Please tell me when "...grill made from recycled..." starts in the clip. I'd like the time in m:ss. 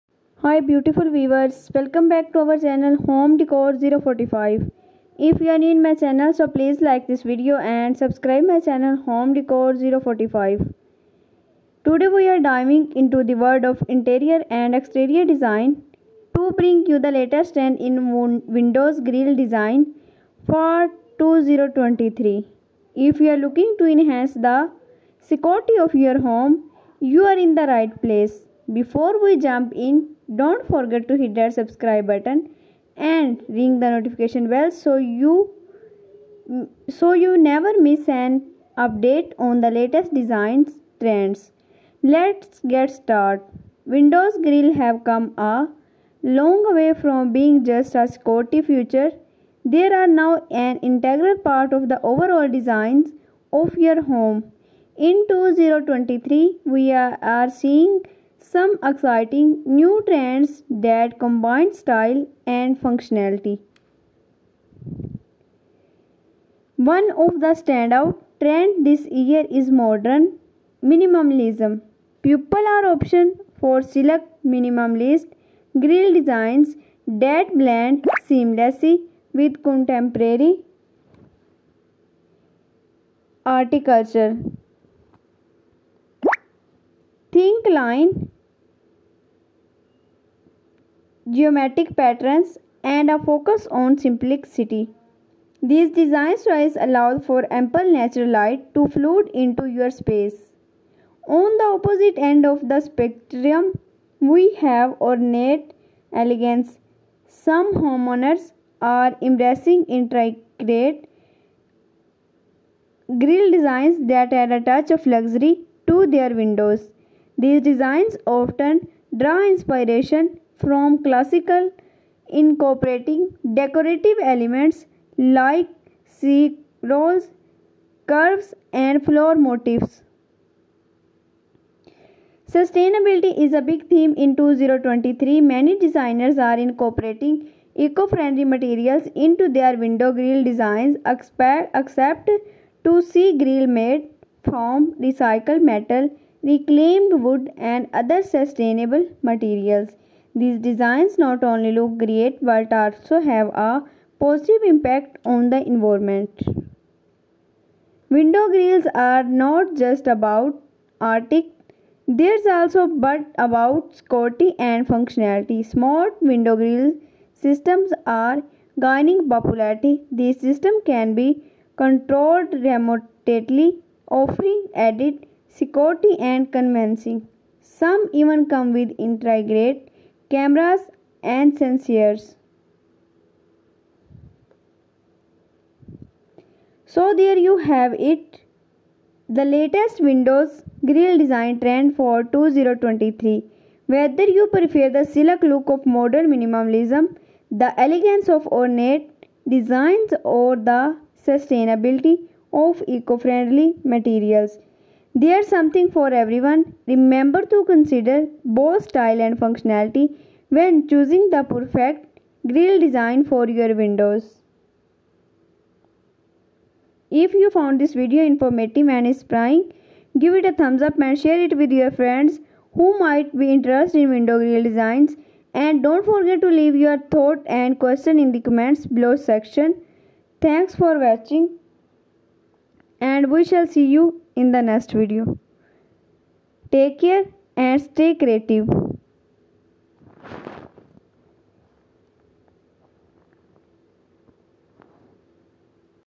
2:23.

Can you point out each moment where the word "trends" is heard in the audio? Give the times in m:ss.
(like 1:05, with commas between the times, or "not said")
0:17, 0:41, 1:00, 1:08, 3:11.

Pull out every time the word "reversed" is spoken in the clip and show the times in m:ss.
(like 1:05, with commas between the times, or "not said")
not said.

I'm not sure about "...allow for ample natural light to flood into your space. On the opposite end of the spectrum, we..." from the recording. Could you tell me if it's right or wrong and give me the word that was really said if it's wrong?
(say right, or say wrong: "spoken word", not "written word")
right.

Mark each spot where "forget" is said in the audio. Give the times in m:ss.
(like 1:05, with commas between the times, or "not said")
0:30, 3:46.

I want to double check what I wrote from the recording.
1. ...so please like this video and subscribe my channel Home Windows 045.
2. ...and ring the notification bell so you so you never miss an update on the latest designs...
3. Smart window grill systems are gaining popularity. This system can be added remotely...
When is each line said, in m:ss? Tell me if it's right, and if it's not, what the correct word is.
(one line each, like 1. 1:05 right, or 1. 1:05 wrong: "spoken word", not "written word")
1. 0:06 wrong: "Decor", not "Windows"
2. 0:32 right
3. 2:45 wrong: "controlled", not "added".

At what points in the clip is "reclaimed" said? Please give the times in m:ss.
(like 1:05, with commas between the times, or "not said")
2:26.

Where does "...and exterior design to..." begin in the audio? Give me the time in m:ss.
0:14.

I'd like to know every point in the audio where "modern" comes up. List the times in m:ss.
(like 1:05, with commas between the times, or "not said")
1:09, 3:15.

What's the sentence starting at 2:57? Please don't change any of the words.
Some even come with integrated cameras and sensors.